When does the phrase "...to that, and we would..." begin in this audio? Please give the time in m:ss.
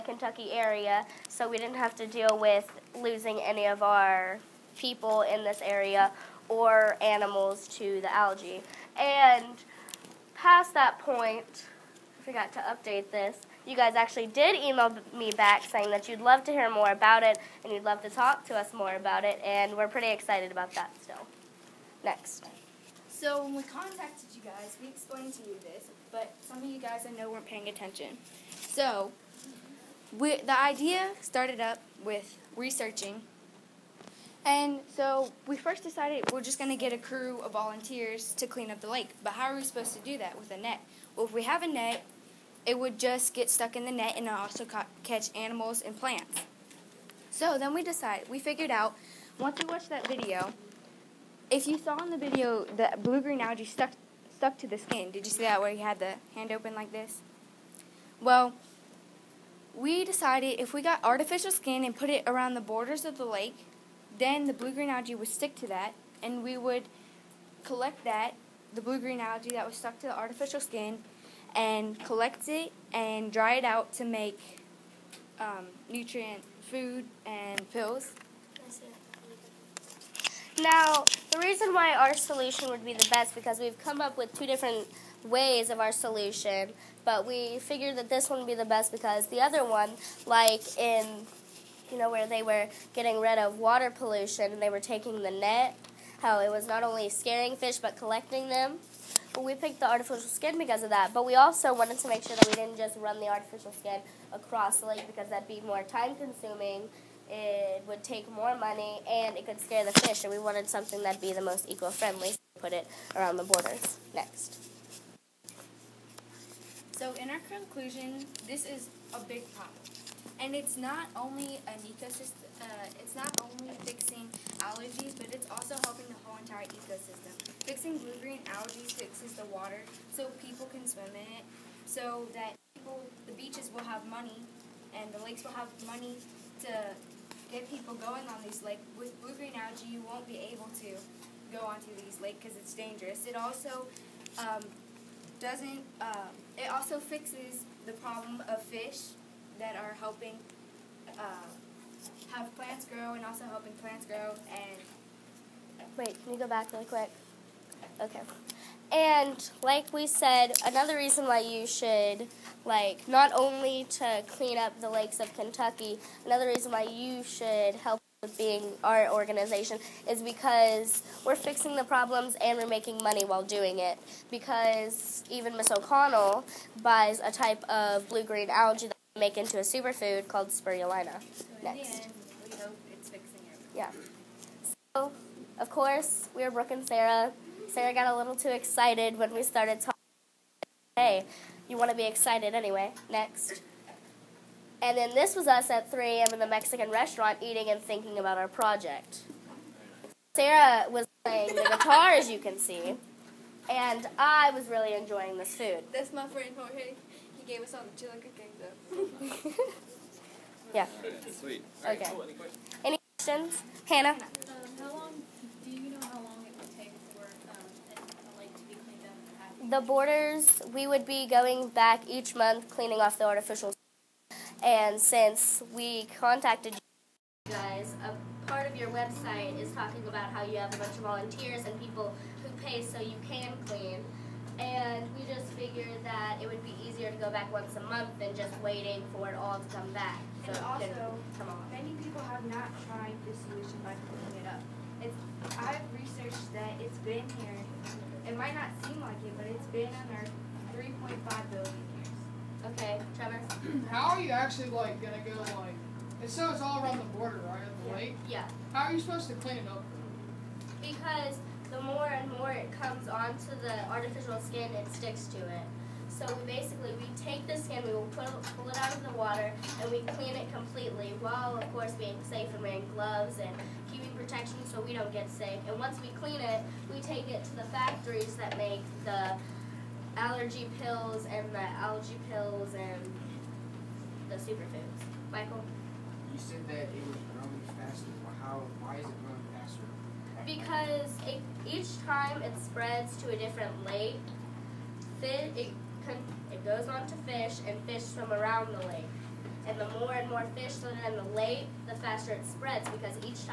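1:05.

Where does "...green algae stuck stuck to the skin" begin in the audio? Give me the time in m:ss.
0:53.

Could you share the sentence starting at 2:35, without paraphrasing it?
Wait, can you go back really quick?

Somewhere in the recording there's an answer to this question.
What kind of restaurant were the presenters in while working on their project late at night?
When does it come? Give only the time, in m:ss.
3:16.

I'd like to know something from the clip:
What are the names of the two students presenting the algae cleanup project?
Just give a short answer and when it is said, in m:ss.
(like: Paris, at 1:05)
Brooke and Sarah, at 3:06.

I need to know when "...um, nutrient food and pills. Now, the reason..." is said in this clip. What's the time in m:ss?
1:15.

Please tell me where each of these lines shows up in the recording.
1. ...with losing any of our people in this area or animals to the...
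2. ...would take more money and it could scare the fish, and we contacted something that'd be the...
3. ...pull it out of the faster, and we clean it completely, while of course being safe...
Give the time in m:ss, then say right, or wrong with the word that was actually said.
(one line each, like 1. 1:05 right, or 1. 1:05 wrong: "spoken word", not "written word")
1. 0:02 right
2. 1:47 wrong: "wanted", not "contacted"
3. 4:28 wrong: "water", not "faster".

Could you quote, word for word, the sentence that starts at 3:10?
Hey, you want to be excited anyway.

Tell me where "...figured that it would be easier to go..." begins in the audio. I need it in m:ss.
3:55.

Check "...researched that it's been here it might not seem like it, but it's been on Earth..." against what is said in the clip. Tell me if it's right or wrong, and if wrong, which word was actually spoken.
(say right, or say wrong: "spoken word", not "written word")
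right.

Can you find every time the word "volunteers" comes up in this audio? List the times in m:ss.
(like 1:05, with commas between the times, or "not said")
0:37, 3:51.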